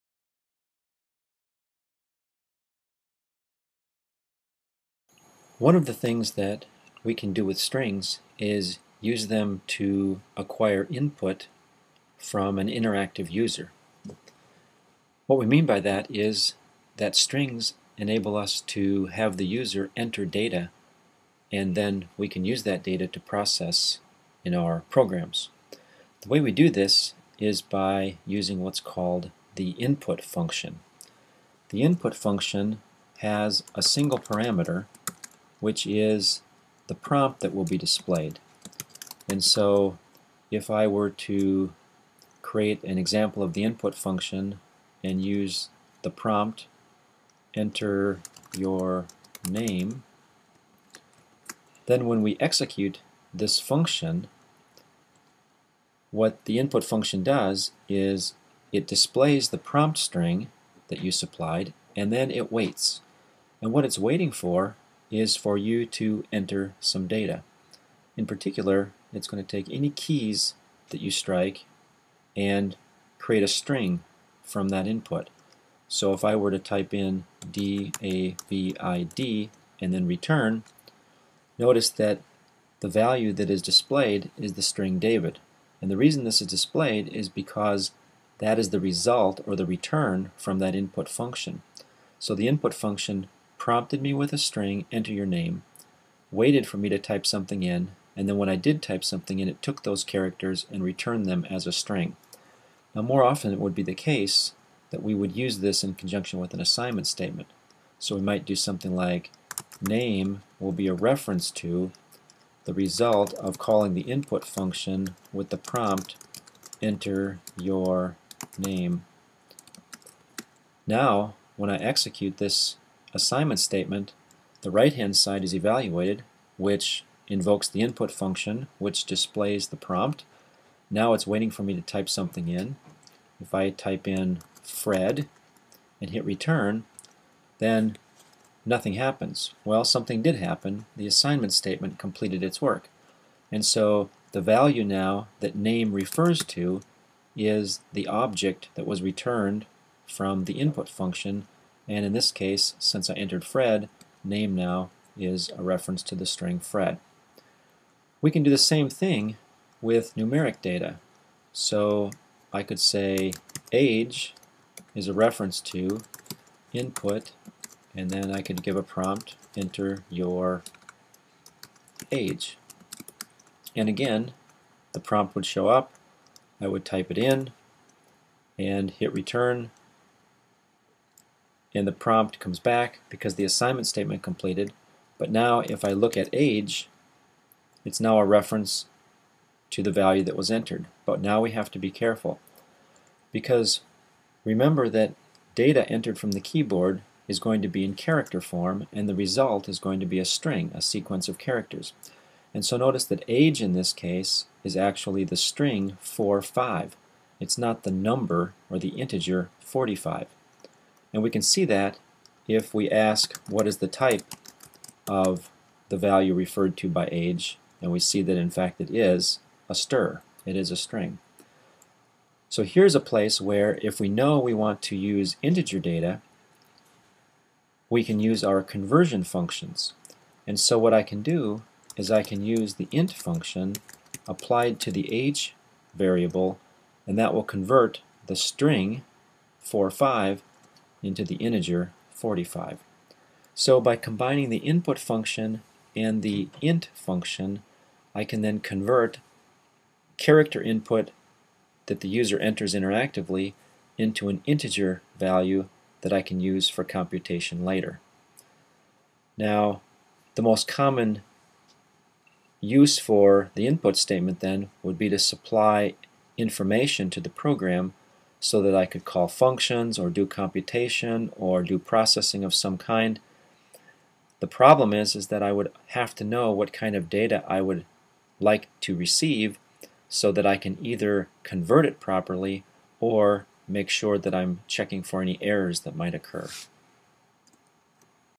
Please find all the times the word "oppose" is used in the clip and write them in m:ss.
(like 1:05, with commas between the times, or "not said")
not said.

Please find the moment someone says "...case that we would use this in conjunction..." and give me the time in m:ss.
1:43.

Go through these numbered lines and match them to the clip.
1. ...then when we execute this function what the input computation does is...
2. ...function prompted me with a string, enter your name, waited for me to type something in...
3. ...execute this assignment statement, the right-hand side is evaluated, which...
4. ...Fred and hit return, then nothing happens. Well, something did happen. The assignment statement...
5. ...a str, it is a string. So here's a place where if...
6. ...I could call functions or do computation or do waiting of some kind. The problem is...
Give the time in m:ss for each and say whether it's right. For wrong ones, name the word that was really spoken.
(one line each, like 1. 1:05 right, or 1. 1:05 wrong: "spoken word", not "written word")
1. 0:51 wrong: "function", not "computation"
2. 1:32 right
3. 2:01 right
4. 2:14 right
5. 3:39 right
6. 4:28 wrong: "processing", not "waiting".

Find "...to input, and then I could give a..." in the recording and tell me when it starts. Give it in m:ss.
2:45.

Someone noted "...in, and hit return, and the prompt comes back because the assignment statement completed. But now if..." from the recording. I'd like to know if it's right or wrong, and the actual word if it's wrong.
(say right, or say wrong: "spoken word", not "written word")
right.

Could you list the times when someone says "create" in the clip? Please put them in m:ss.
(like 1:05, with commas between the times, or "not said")
0:42, 1:13.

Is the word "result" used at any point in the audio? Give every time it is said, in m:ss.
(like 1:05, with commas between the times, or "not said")
1:28, 1:52, 3:19.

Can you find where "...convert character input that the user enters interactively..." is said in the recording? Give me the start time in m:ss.
4:08.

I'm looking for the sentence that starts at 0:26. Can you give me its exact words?
The way we do this is by using what's called the input function.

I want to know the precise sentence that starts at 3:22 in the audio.
And so notice that age in this case is actually the string 4, 5.